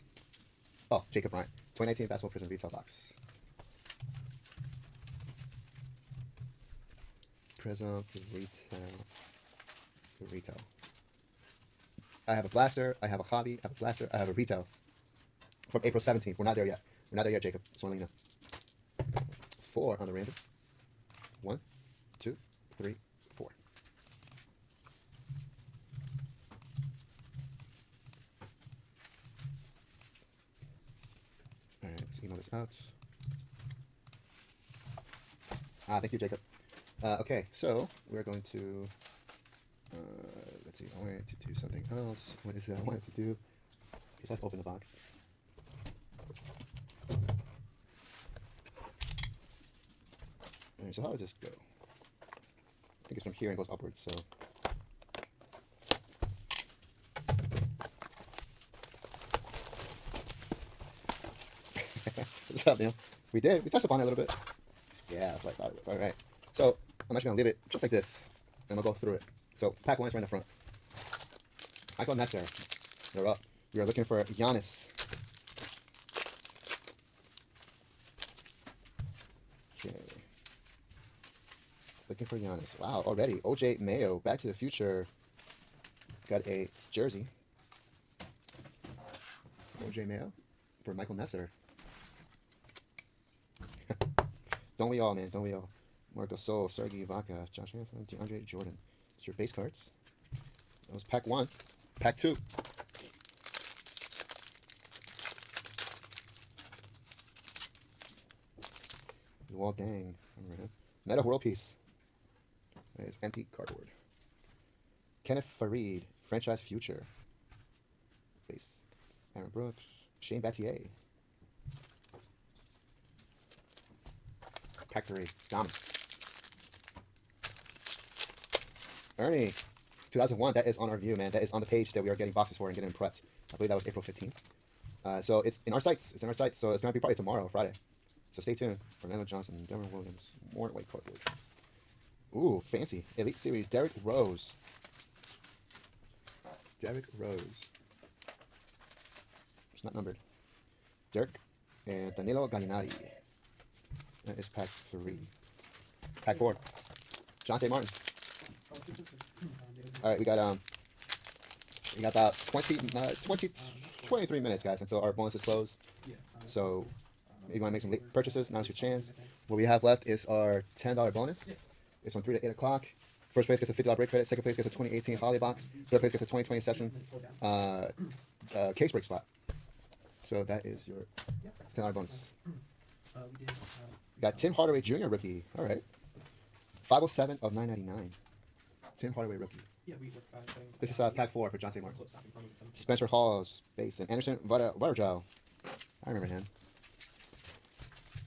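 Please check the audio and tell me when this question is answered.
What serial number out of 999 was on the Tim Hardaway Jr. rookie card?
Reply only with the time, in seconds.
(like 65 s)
186 s.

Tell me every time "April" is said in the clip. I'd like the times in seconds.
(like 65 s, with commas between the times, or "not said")
15 s, 133 s.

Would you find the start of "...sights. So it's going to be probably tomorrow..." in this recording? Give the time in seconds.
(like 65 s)
136 s.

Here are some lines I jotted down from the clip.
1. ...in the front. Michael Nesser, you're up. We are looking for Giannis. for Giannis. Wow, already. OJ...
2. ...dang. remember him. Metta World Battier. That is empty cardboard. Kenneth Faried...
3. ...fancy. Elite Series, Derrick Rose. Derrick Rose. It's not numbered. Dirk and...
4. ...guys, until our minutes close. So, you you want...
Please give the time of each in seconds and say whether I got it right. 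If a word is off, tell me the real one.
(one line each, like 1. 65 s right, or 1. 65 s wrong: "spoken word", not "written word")
1. 70 s right
2. 109 s wrong: "Peace", not "Battier"
3. 142 s right
4. 164 s wrong: "bonuses", not "minutes".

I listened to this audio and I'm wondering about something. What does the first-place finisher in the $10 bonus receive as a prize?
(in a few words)
$50 break credit.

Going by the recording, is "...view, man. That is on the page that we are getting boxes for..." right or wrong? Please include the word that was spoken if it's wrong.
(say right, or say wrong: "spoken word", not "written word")
right.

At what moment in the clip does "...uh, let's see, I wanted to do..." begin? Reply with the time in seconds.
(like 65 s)
39 s.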